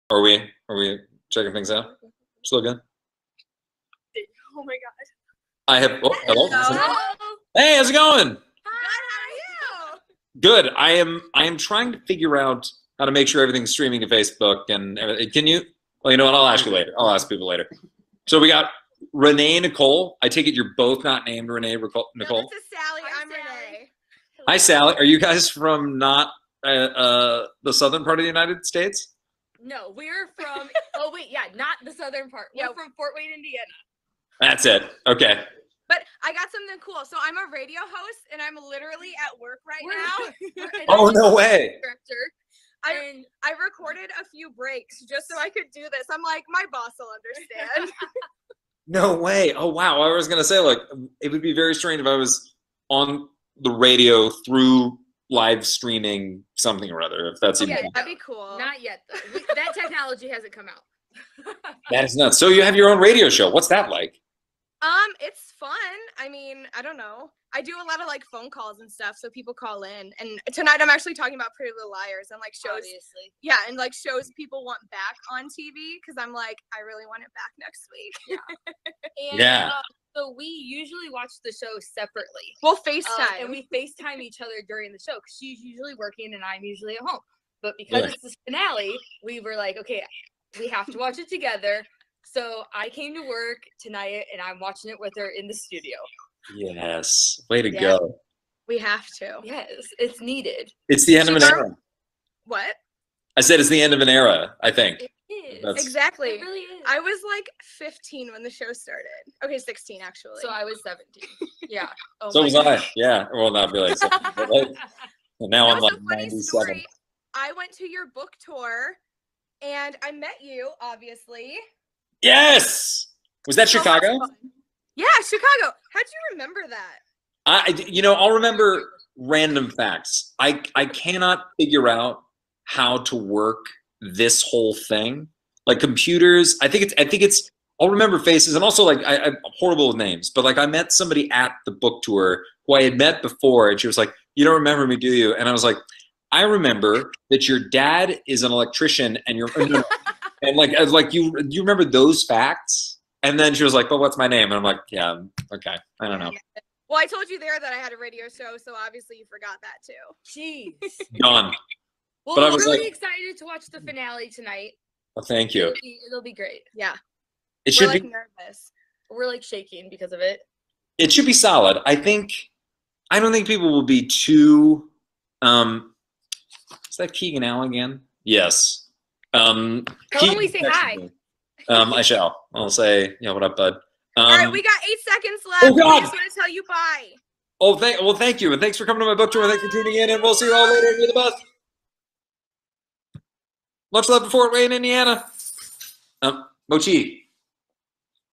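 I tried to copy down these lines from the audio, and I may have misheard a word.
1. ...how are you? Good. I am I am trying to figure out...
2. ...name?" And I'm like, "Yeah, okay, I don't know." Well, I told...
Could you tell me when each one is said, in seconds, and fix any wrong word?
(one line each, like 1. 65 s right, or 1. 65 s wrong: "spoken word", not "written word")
1. 8 s right
2. 154 s right.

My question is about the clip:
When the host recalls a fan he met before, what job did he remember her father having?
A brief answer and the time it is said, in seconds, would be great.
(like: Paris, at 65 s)
Electrician, at 148 s.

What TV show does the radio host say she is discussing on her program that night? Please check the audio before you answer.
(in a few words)
Pretty Little Liars.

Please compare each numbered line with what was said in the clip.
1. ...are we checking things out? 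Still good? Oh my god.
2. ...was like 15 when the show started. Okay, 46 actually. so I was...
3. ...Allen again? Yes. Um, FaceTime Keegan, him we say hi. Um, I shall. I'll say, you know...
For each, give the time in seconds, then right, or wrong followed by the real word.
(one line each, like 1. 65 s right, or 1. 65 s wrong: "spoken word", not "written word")
1. 0 s right
2. 106 s wrong: "16", not "46"
3. 177 s wrong: "Tell", not "FaceTime".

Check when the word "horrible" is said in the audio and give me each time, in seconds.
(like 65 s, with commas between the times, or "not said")
139 s.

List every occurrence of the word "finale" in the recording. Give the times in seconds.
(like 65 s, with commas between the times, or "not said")
88 s, 163 s.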